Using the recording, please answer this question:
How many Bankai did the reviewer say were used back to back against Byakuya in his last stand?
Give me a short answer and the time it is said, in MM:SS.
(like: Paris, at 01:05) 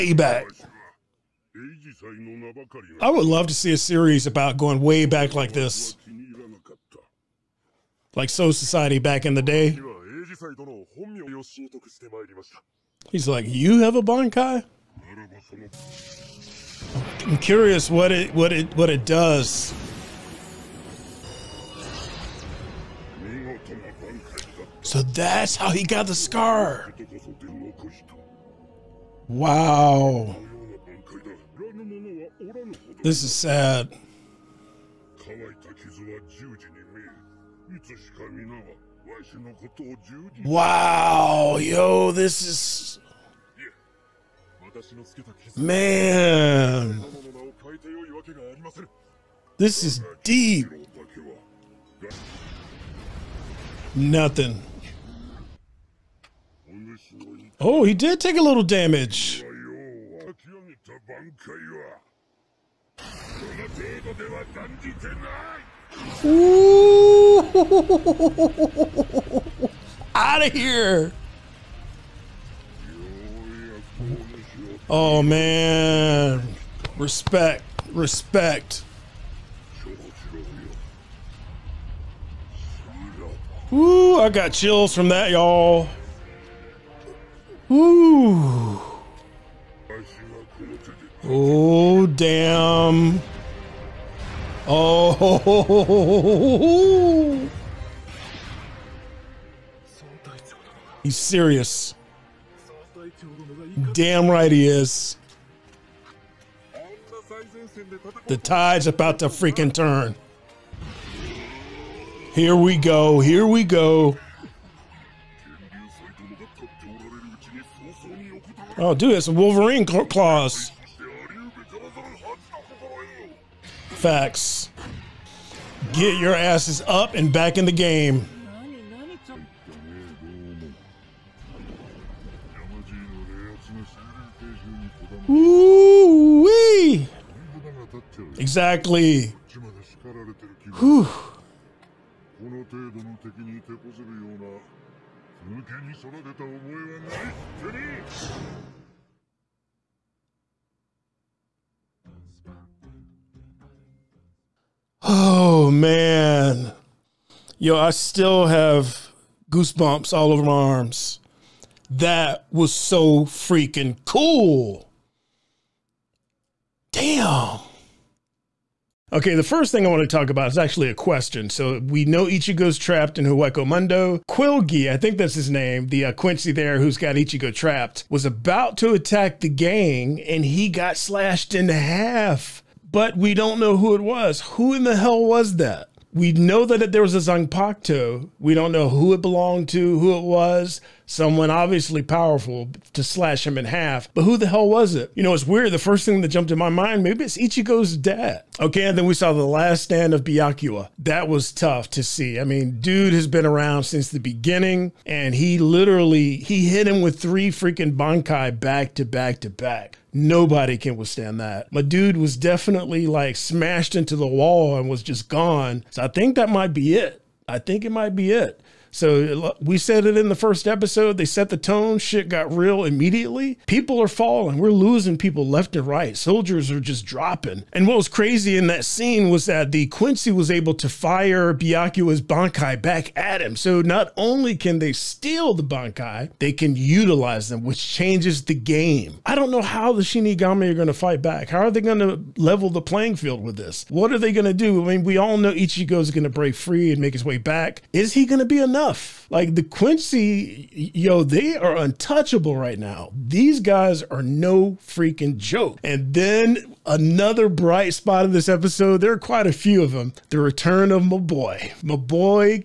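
3, at 03:27.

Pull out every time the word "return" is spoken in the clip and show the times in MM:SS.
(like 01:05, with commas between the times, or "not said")
04:20.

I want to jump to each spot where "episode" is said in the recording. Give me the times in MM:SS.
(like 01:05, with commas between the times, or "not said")
03:40, 04:18.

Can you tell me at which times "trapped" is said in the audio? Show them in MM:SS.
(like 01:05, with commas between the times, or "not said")
02:52, 02:57.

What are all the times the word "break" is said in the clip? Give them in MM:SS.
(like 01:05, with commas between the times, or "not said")
04:06.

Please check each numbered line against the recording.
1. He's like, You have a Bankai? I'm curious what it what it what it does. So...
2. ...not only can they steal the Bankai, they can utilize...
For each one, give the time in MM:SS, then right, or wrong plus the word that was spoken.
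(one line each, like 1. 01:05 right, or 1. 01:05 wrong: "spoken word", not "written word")
1. 00:13 right
2. 03:53 right.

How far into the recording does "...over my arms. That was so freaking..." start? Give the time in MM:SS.
02:40.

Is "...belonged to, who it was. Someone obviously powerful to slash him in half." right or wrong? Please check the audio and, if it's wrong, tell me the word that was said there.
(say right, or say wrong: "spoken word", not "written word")
right.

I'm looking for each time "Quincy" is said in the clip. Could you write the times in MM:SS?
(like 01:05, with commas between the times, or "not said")
02:56, 03:49, 04:09.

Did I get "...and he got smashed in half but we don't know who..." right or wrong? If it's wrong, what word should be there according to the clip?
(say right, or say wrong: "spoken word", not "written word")
wrong: "slashed", not "smashed".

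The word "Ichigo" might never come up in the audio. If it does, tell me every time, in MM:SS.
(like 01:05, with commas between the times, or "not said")
02:52, 02:57, 03:17, 04:05.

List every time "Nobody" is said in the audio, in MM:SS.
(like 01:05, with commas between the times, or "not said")
03:30.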